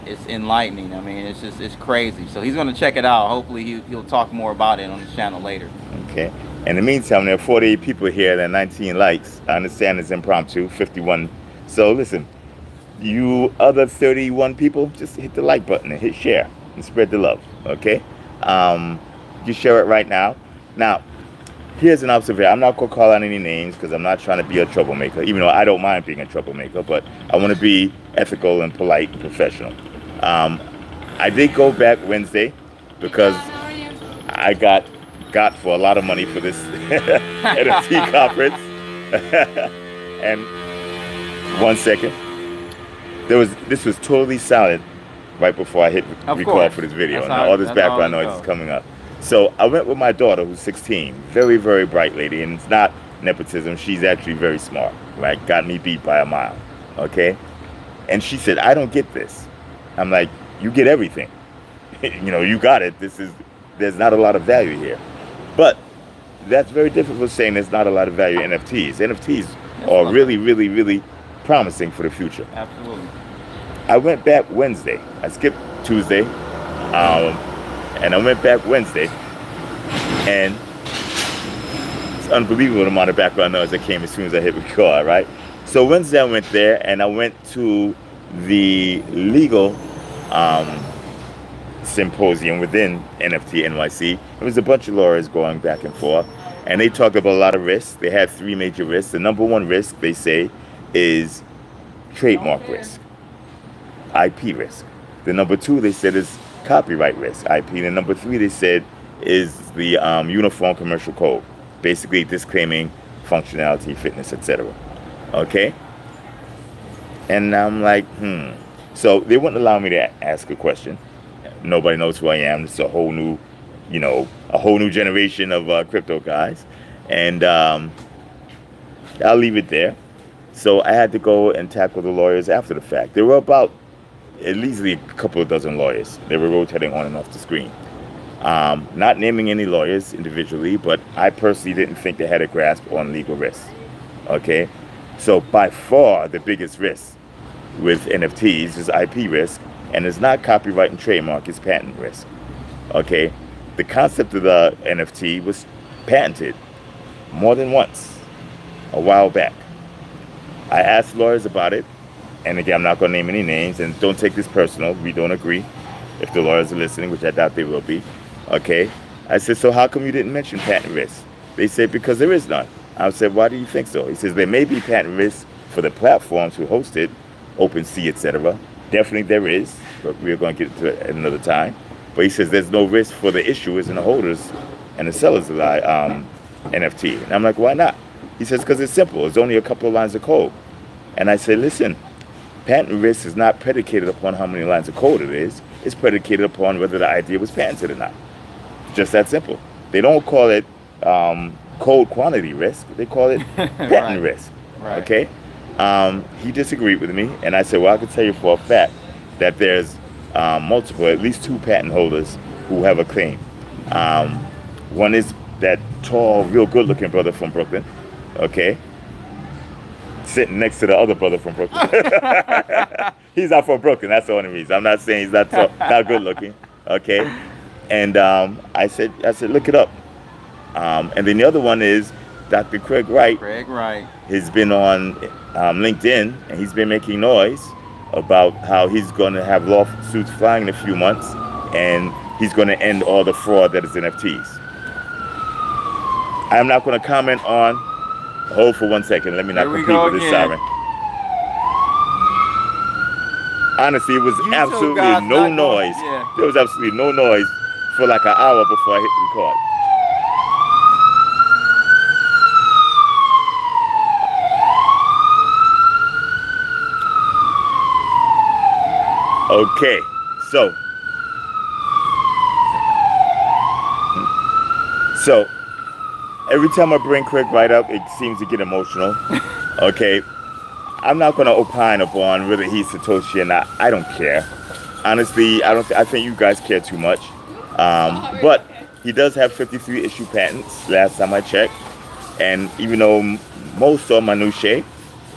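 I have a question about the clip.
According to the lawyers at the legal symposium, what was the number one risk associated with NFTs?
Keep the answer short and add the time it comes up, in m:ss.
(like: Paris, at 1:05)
Trademark risk, at 1:42.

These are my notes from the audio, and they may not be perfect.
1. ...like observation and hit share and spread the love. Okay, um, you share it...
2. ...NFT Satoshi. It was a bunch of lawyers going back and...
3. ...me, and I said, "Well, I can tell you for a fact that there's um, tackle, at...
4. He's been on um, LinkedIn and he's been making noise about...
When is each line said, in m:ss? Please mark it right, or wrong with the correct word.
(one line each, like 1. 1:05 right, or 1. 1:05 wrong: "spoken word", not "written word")
1. 0:15 wrong: "button", not "observation"
2. 1:33 wrong: "NYC", not "Satoshi"
3. 3:27 wrong: "multiple", not "tackle"
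4. 3:54 right.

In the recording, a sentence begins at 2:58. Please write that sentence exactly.
Definitely there is, but we're going to get to it at another time.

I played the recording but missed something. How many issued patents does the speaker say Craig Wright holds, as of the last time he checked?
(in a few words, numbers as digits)
53.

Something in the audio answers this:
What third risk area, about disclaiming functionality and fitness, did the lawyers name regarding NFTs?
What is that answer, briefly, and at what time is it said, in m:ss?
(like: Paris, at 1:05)
Uniform Commercial Code, at 1:50.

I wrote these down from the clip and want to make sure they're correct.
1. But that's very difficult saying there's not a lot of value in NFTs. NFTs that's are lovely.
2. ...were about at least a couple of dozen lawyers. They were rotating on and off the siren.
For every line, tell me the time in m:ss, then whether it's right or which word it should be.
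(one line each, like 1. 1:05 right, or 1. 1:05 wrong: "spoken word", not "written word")
1. 1:05 right
2. 2:13 wrong: "screen", not "siren".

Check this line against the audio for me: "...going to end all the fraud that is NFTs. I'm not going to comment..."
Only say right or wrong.
right.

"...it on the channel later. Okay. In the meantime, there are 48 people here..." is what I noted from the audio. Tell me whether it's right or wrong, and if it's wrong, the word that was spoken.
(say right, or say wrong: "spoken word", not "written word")
right.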